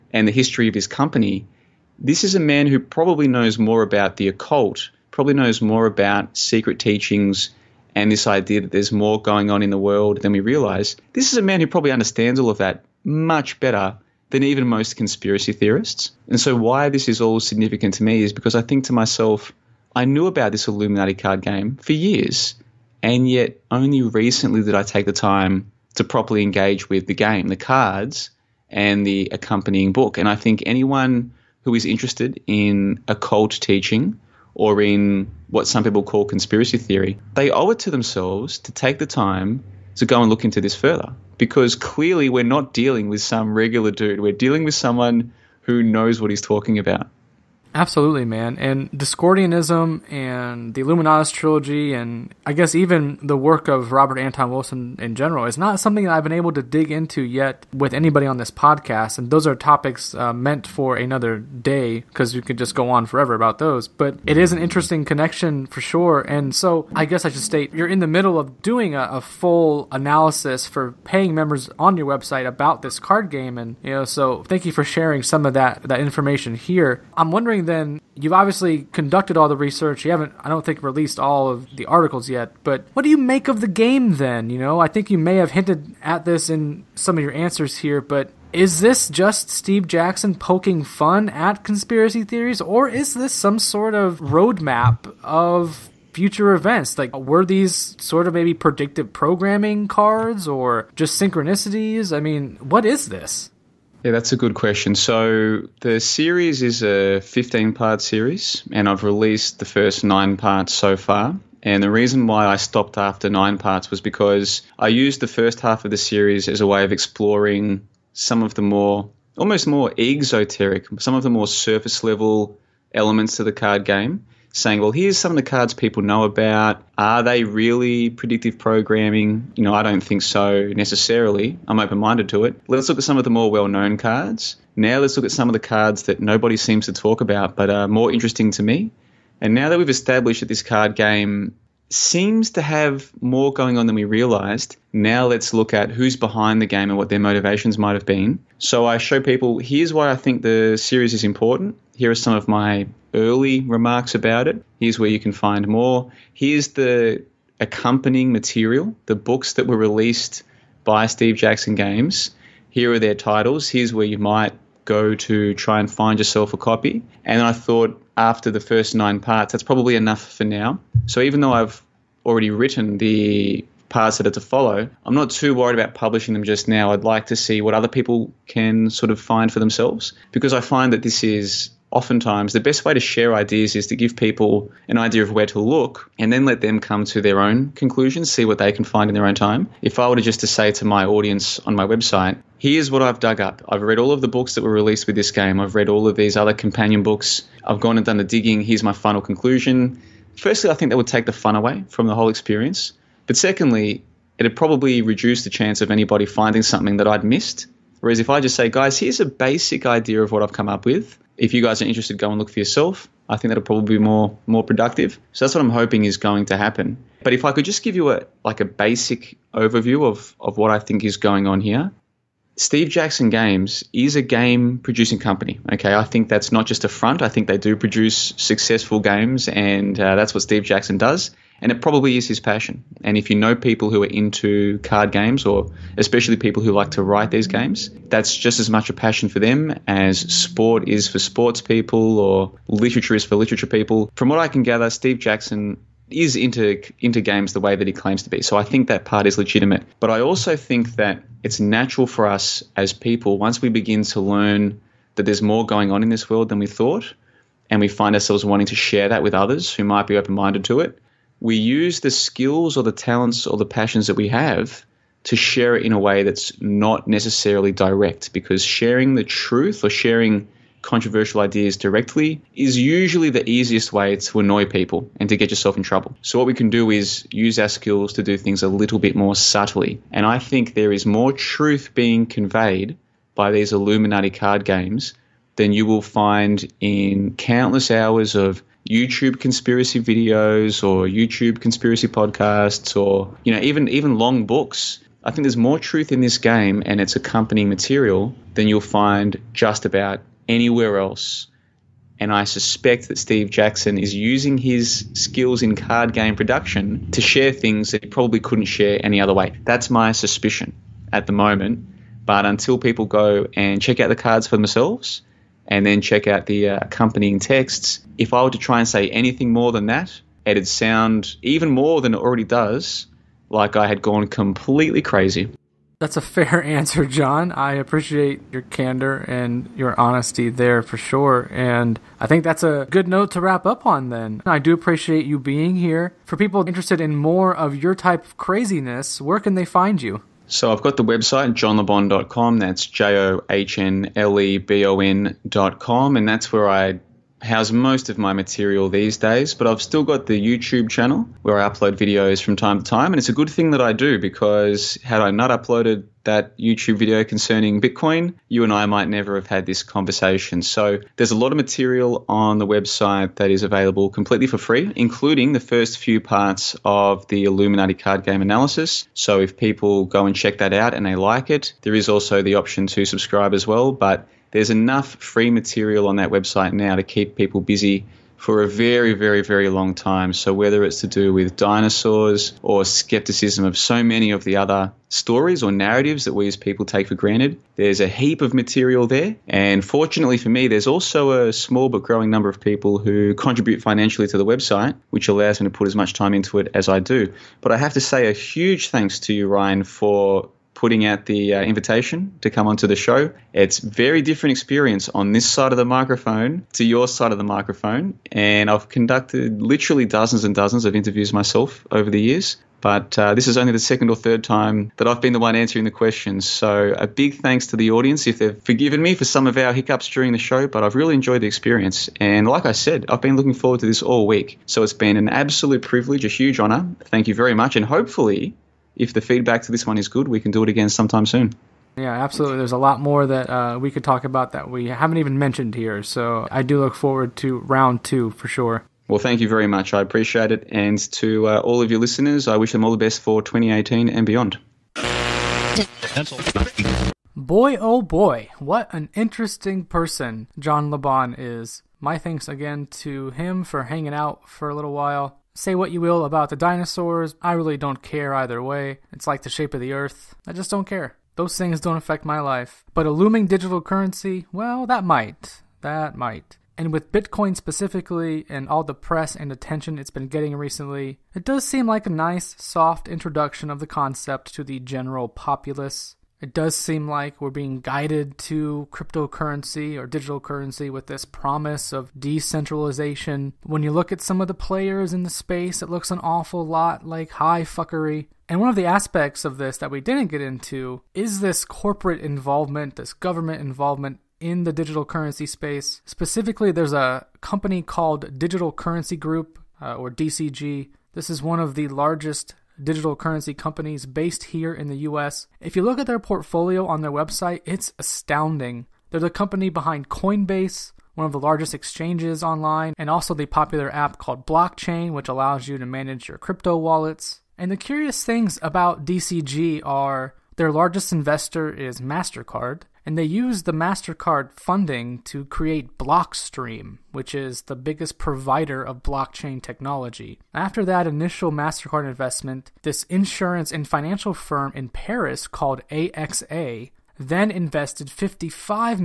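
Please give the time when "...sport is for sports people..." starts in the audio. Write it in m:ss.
4:00.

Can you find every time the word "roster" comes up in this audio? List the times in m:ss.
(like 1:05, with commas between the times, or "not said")
not said.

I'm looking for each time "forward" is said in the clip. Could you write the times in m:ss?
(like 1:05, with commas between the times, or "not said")
7:03, 7:16.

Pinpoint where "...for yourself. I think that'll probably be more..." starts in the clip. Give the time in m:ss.
3:32.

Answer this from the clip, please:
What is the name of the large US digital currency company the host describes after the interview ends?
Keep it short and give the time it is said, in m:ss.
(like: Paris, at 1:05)
Digital Currency Group, at 8:18.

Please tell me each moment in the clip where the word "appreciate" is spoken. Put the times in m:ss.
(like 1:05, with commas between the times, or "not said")
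5:27, 5:34, 7:20.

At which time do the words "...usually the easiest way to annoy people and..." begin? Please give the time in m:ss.
4:32.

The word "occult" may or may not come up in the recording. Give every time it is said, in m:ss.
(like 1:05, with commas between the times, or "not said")
0:04, 0:33.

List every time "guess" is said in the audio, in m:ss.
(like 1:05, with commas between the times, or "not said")
0:52, 1:07.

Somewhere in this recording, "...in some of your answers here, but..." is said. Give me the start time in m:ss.
1:26.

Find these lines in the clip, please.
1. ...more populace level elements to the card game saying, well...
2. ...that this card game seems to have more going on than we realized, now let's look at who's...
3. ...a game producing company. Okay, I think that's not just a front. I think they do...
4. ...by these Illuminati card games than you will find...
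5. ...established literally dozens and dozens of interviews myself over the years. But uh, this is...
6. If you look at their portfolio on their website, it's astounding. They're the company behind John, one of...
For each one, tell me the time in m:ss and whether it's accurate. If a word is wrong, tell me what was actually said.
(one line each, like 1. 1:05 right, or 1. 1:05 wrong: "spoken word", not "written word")
1. 2:01 wrong: "surface", not "populace"
2. 2:20 right
3. 3:44 right
4. 4:43 right
5. 6:48 wrong: "conducted", not "established"
6. 8:25 wrong: "Coinbase", not "John".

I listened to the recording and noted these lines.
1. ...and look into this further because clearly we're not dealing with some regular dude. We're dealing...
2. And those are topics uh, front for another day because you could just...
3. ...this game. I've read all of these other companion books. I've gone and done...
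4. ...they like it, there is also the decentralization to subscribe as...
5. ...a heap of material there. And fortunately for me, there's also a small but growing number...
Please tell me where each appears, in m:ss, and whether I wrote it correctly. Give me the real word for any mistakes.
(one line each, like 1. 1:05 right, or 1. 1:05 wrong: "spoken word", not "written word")
1. 0:40 right
2. 0:59 wrong: "meant", not "front"
3. 3:15 right
4. 6:11 wrong: "option", not "decentralization"
5. 6:28 right.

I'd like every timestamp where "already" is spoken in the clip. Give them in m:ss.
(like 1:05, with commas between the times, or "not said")
2:52, 5:22.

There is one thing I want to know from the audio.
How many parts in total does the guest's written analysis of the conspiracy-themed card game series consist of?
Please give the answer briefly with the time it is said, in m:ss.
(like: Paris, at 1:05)
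15, at 1:47.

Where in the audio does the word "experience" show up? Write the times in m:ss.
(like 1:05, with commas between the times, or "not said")
3:22, 6:44, 7:01.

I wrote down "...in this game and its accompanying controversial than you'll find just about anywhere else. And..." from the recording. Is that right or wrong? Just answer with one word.
wrong.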